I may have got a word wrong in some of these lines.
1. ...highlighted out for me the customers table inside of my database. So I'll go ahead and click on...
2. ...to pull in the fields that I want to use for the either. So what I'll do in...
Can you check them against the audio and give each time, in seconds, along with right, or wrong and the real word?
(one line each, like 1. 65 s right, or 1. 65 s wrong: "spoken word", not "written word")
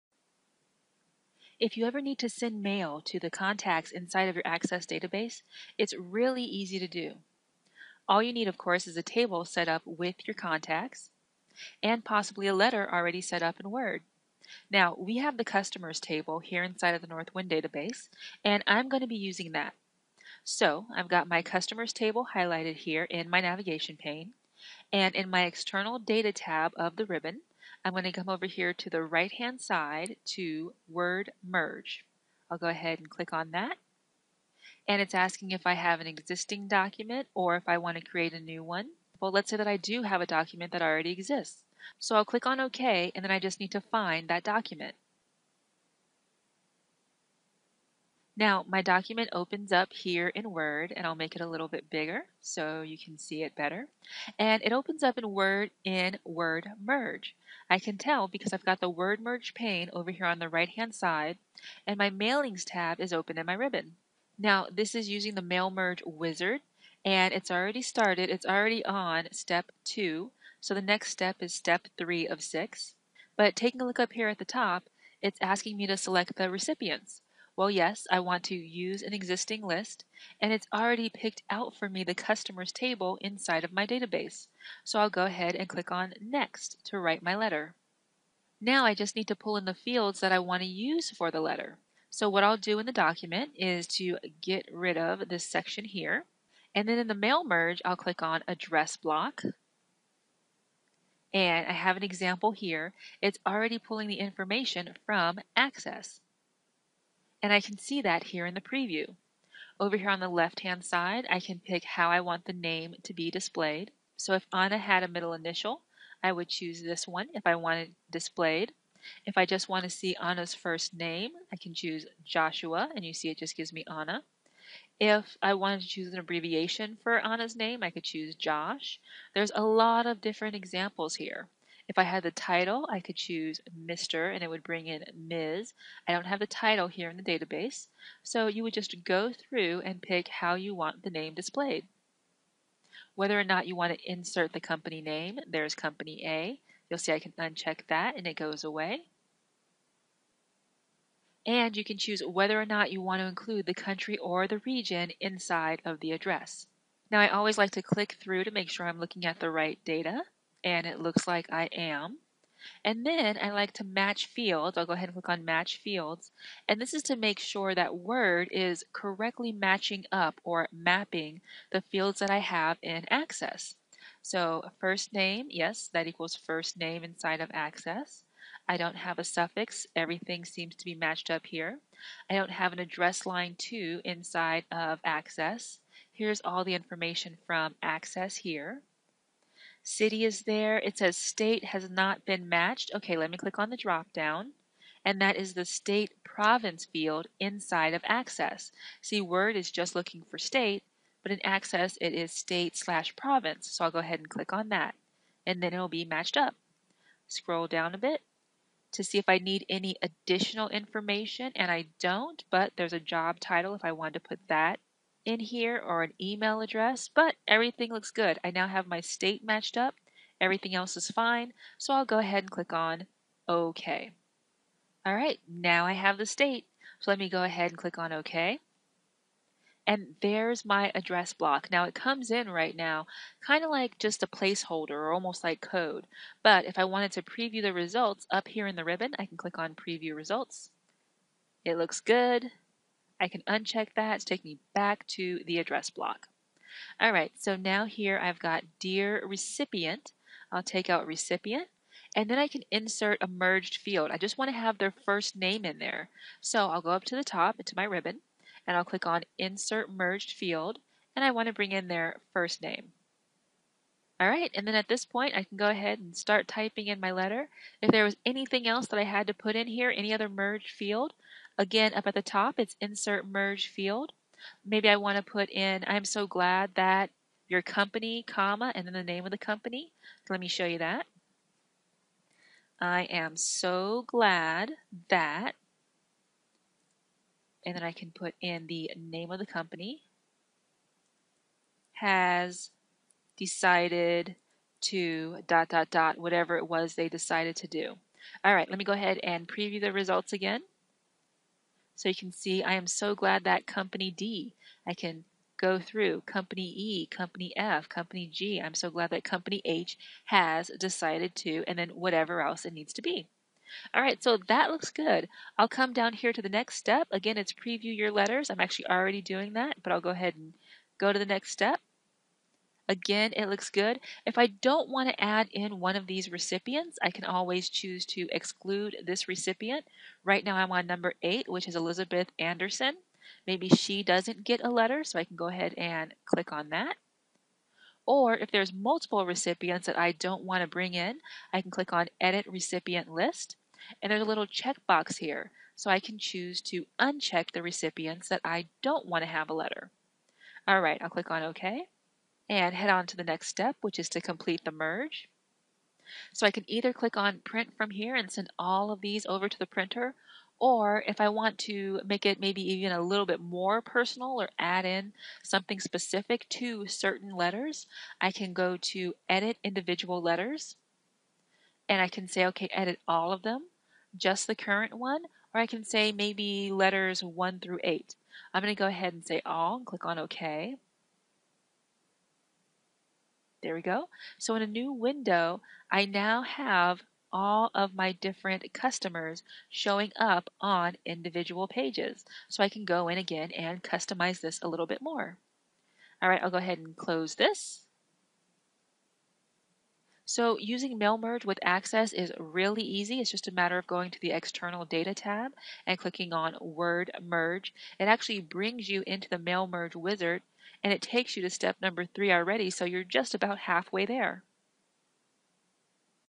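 1. 81 s wrong: "picked", not "highlighted"
2. 89 s wrong: "letter", not "either".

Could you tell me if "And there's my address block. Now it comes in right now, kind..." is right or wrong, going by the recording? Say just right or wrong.
right.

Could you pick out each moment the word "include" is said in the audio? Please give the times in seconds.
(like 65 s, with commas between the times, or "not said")
153 s.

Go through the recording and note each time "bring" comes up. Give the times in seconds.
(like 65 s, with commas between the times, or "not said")
134 s, 261 s, 340 s, 408 s.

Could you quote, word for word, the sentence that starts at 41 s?
So I'll click on OK and then I just need to find that document.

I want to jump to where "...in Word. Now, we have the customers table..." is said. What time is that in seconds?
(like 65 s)
13 s.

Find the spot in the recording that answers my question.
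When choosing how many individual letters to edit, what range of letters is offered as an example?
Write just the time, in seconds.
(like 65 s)
377 s.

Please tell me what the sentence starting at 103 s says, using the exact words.
It's already pulling the information from Access and I can see that here in the preview.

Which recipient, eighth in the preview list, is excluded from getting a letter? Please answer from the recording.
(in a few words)
Elizabeth Anderson.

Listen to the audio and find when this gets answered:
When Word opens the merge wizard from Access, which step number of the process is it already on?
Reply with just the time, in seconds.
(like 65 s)
69 s.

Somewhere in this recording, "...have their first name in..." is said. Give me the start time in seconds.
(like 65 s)
254 s.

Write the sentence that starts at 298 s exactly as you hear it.
All right, let me go ahead and preview the results again.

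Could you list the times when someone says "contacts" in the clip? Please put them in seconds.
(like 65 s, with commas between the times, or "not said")
3 s, 10 s.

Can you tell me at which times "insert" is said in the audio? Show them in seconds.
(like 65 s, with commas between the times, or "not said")
144 s, 252 s, 259 s, 272 s.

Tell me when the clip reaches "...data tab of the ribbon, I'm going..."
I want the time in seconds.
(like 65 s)
25 s.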